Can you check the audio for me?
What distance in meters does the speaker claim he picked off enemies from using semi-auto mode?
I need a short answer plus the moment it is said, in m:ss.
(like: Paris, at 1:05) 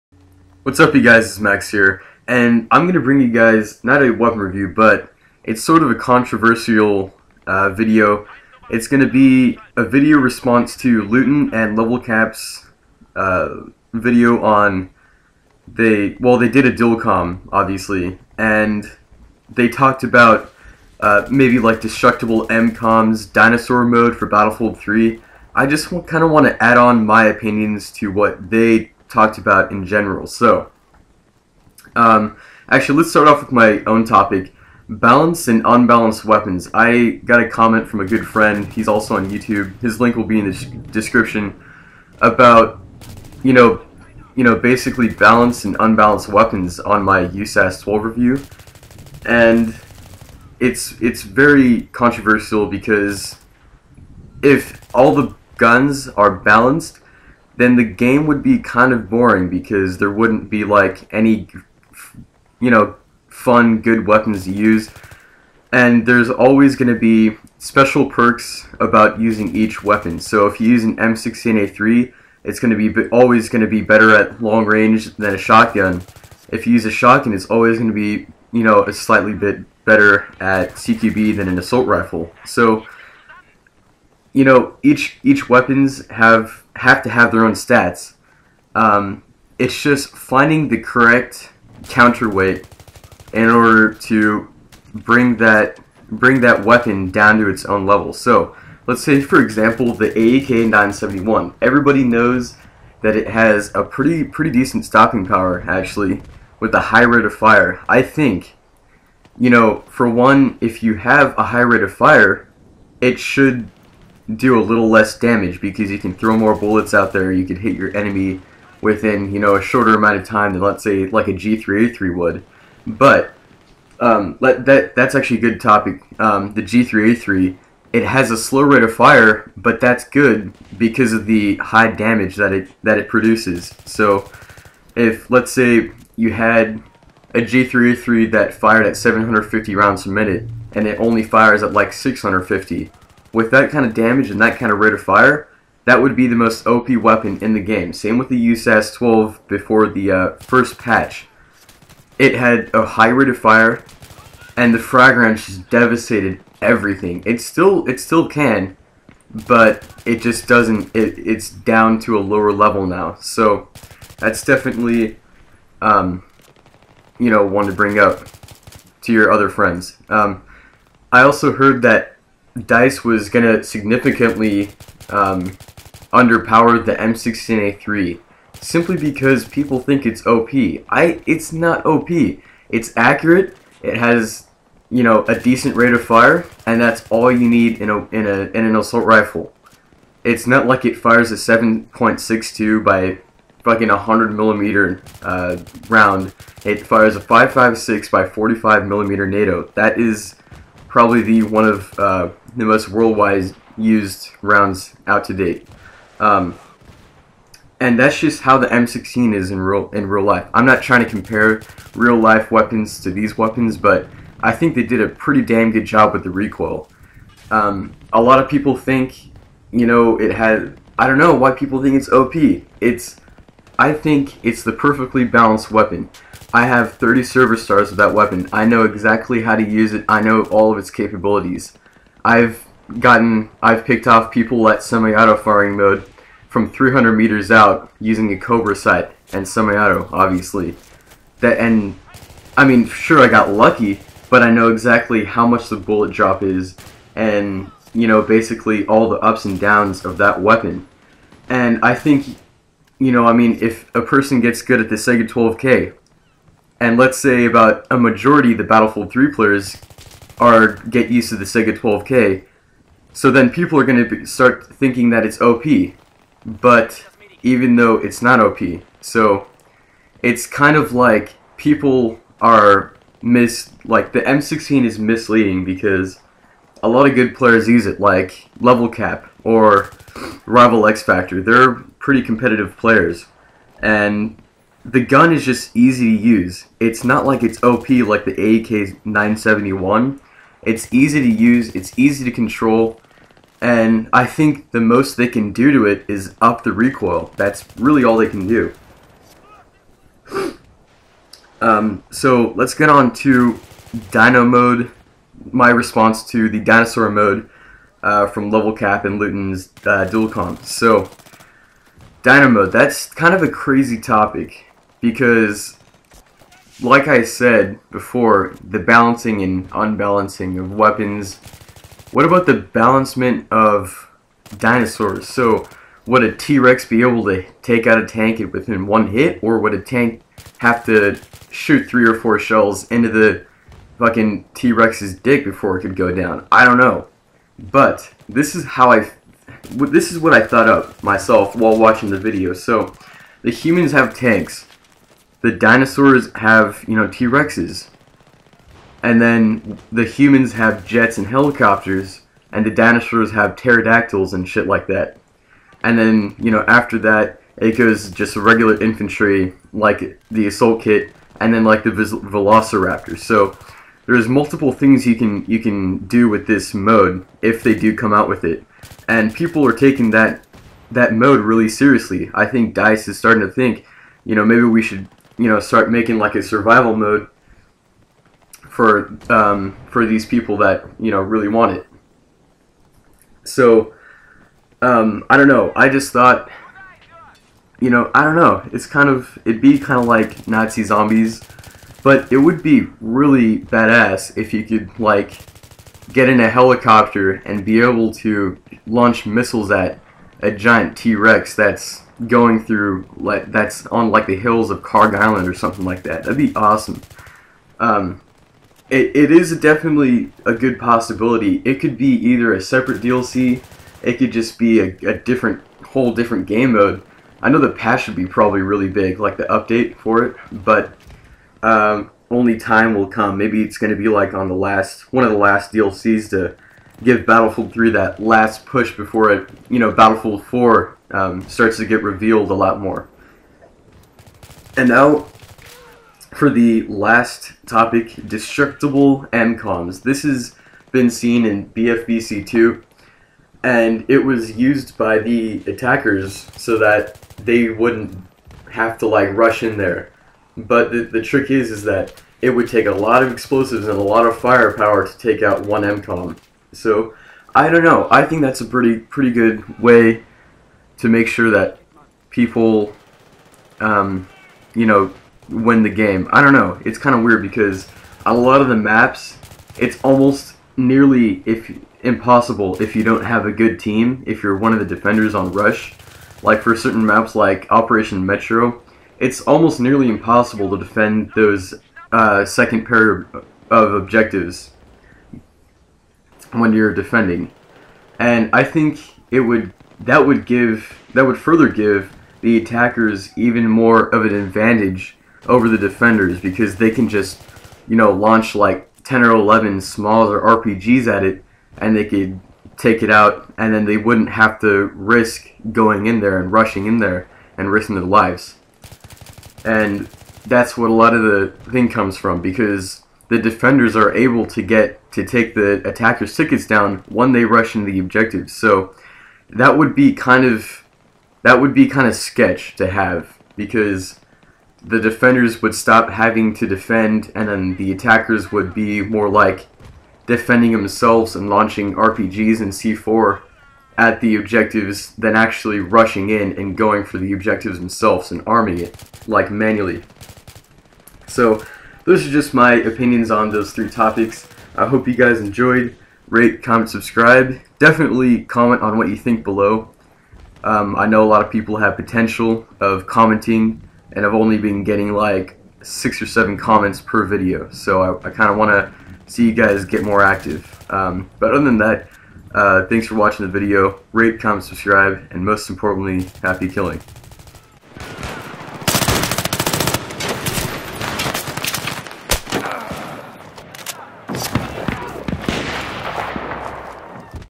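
300 meters, at 3:56.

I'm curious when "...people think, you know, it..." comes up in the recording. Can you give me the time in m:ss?
3:38.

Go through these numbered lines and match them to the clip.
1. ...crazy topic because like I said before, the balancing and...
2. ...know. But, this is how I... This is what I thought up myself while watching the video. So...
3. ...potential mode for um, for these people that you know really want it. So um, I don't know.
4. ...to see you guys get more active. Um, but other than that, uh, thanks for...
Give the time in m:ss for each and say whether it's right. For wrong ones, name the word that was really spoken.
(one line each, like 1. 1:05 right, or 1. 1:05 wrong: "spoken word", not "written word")
1. 5:13 right
2. 5:36 right
3. 6:16 wrong: "survival", not "potential"
4. 9:18 right.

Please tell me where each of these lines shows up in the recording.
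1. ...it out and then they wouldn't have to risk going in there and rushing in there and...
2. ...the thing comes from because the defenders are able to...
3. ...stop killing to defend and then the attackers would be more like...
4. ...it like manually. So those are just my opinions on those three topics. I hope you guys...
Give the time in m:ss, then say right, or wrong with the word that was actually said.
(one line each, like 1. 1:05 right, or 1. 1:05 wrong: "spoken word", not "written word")
1. 8:23 right
2. 8:31 right
3. 8:45 wrong: "having", not "killing"
4. 8:58 right.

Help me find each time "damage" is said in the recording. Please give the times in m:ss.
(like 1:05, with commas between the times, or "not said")
1:55, 2:11, 2:23.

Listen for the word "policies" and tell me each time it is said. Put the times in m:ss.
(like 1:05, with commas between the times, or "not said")
not said.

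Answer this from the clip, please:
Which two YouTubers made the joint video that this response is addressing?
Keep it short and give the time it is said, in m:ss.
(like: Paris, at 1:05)
Leutin and Level Cap, at 0:11.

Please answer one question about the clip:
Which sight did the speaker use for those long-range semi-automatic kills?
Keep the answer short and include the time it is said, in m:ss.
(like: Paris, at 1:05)
Cobra sight, at 3:58.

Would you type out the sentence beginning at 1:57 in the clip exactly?
You can hit your enemy within you know a shorter amount of time than let's say like a 3 a G3A3 would.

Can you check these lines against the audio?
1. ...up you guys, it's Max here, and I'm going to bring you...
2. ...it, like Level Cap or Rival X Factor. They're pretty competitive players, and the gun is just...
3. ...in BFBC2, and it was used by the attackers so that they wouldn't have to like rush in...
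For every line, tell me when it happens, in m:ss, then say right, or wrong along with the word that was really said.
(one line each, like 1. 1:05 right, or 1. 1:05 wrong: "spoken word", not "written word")
1. 0:00 right
2. 4:37 right
3. 7:21 right.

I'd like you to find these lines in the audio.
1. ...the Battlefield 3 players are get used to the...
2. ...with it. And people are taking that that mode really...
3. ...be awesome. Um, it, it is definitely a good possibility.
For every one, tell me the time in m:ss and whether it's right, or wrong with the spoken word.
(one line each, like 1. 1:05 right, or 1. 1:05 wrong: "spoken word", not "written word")
1. 4:18 right
2. 6:08 right
3. 6:46 right.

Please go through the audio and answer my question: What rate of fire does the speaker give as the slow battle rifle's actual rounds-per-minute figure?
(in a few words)
650.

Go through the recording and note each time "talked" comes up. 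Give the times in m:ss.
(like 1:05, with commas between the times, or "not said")
0:19, 0:29.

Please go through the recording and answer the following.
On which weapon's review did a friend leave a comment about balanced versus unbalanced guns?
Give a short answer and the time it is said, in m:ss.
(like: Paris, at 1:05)
USAS 12, at 0:47.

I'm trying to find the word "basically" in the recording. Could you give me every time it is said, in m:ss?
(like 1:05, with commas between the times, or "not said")
0:44, 4:08.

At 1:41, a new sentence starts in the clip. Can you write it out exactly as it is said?
Everybody knows that it has a pretty pretty decent stopping power actually with a high rate of fire.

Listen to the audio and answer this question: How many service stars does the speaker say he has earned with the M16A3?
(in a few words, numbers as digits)
30.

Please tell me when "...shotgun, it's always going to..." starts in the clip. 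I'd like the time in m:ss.
1:16.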